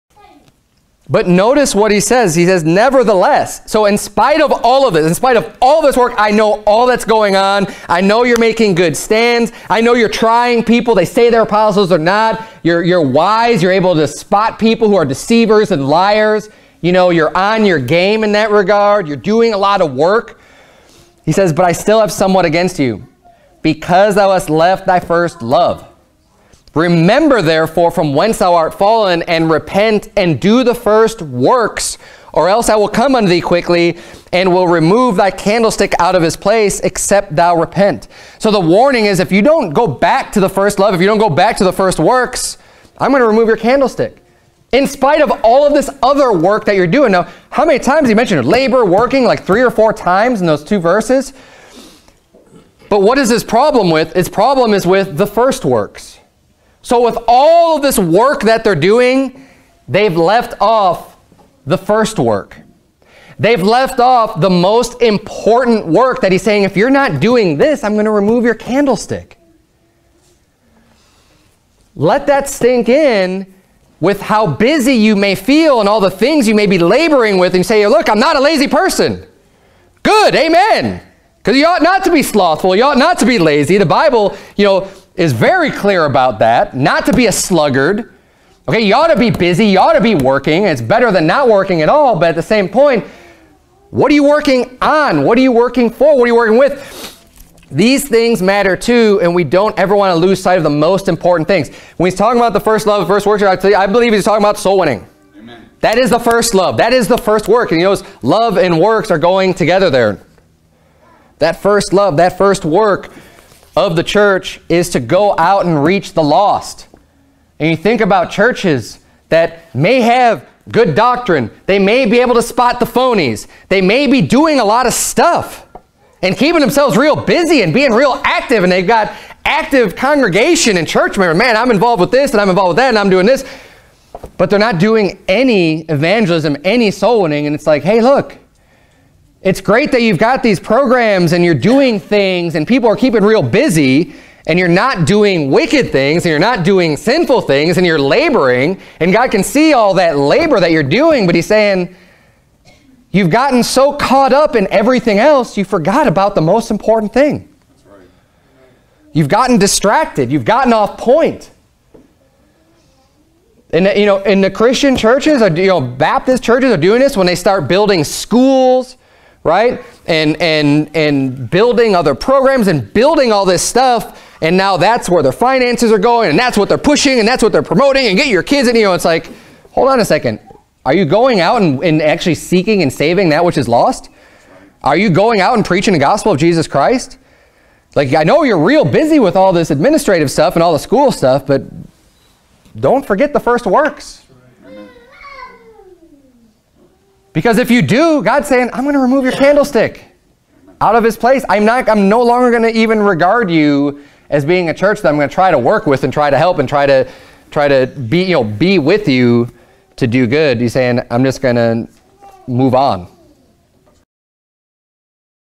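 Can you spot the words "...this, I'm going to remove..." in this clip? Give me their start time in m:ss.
1:07.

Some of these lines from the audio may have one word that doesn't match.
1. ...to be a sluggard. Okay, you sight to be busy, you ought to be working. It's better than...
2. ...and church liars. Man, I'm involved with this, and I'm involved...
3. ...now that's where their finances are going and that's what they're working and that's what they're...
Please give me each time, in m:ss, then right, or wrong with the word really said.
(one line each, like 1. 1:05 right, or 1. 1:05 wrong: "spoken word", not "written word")
1. 1:27 wrong: "ought", not "sight"
2. 2:10 wrong: "members", not "liars"
3. 2:54 wrong: "pushing", not "working".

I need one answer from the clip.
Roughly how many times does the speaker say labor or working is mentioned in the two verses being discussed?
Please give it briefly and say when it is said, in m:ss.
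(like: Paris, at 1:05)
3 or 4 times, at 0:49.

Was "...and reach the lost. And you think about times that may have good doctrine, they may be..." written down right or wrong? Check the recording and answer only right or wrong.
wrong.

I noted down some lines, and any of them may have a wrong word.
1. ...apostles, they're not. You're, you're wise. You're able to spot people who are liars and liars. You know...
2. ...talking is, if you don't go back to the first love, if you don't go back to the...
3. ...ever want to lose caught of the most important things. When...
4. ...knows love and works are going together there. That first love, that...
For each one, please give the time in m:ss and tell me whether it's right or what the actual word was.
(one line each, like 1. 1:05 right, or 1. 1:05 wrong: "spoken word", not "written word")
1. 0:11 wrong: "deceivers", not "liars"
2. 0:38 wrong: "warning", not "talking"
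3. 1:39 wrong: "sight", not "caught"
4. 1:47 right.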